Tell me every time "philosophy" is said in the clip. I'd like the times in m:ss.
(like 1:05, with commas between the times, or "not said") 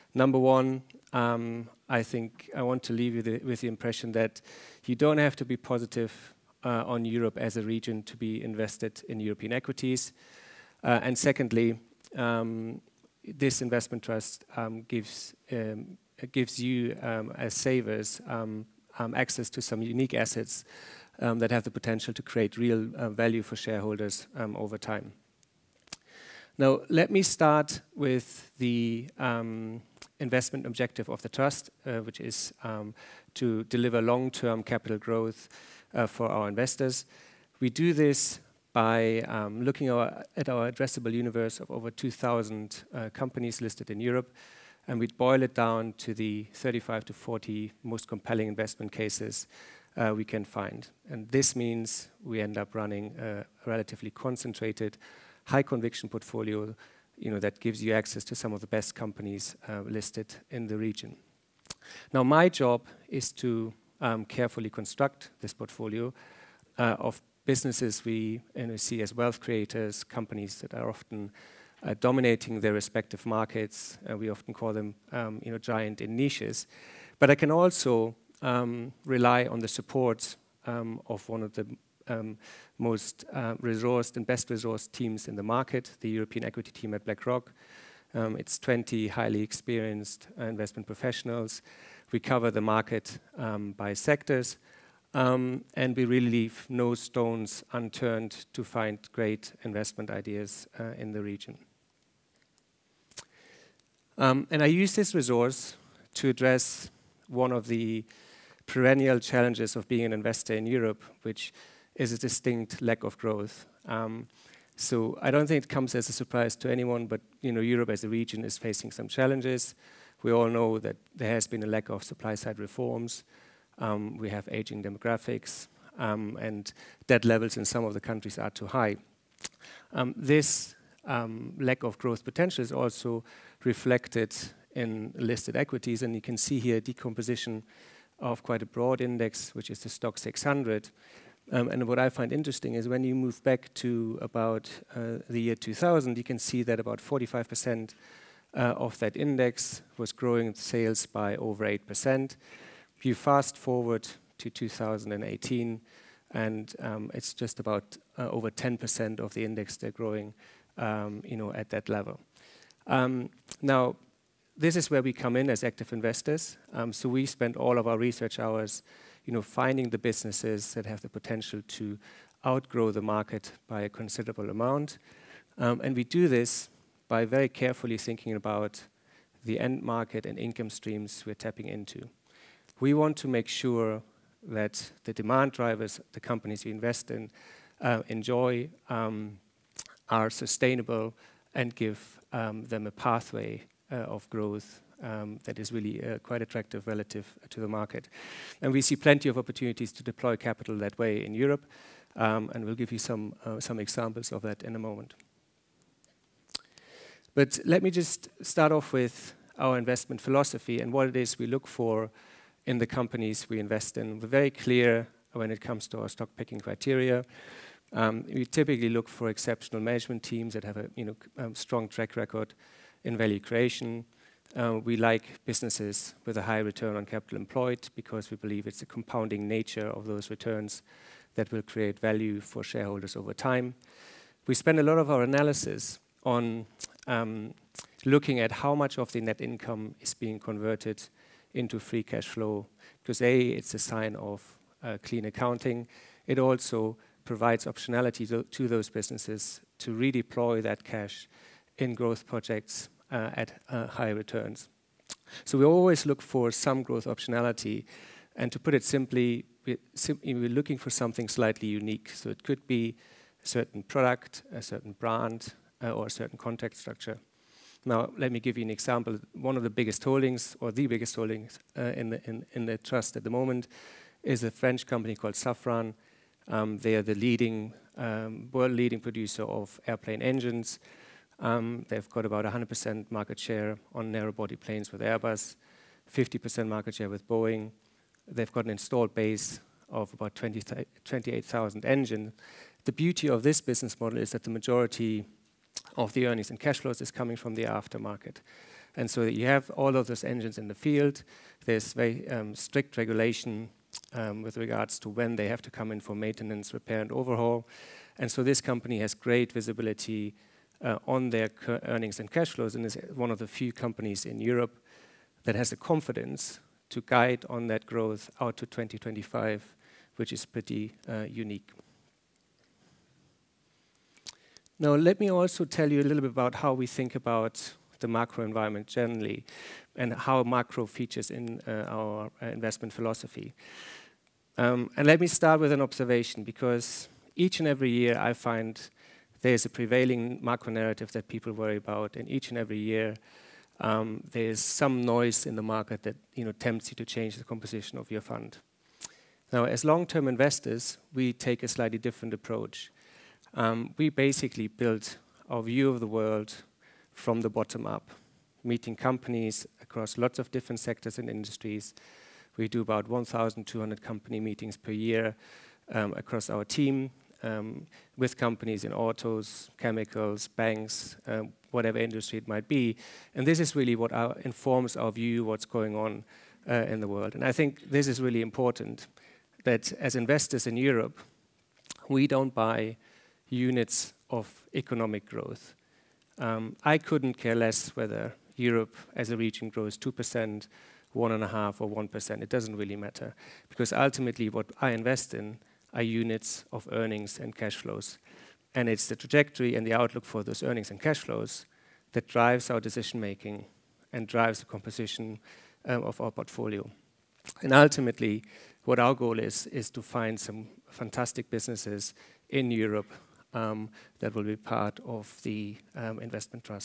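3:30, 5:32.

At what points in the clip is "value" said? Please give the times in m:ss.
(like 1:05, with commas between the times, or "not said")
0:23, 3:43, 3:51.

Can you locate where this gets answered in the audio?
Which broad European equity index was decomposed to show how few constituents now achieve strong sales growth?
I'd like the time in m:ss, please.
2:19.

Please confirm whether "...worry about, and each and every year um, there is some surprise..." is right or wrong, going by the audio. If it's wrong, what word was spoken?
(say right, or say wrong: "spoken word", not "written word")
wrong: "noise", not "surprise".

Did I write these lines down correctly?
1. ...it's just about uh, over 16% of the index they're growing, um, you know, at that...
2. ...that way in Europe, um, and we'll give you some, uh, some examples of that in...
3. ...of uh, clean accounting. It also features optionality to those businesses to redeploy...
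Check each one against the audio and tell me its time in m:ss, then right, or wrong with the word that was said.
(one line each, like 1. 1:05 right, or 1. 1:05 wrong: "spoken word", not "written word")
1. 2:37 wrong: "10", not "16"
2. 3:20 right
3. 4:04 wrong: "provides", not "features".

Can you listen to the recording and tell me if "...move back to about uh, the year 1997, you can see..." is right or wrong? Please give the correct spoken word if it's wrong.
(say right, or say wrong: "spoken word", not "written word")
wrong: "2000", not "1997".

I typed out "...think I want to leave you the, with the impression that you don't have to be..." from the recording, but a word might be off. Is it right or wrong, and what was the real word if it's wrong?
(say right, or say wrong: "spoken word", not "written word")
right.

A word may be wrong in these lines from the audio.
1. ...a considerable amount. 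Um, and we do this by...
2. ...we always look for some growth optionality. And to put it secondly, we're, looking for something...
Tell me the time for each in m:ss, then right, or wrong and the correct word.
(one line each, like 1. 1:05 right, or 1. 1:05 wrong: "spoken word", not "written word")
1. 2:53 right
2. 4:15 wrong: "simply", not "secondly".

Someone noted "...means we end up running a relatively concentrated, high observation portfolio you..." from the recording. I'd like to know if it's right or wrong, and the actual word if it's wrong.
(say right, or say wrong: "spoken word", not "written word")
wrong: "conviction", not "observation".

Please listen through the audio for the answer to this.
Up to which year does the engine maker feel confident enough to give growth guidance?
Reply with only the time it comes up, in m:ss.
5:18.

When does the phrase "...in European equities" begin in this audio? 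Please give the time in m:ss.
0:09.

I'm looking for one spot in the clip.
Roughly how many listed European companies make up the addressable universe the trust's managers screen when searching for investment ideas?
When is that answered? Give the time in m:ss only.
0:41.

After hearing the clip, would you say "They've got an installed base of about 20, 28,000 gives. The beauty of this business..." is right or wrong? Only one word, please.
wrong.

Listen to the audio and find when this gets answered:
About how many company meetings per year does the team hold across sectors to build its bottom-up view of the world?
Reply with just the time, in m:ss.
6:03.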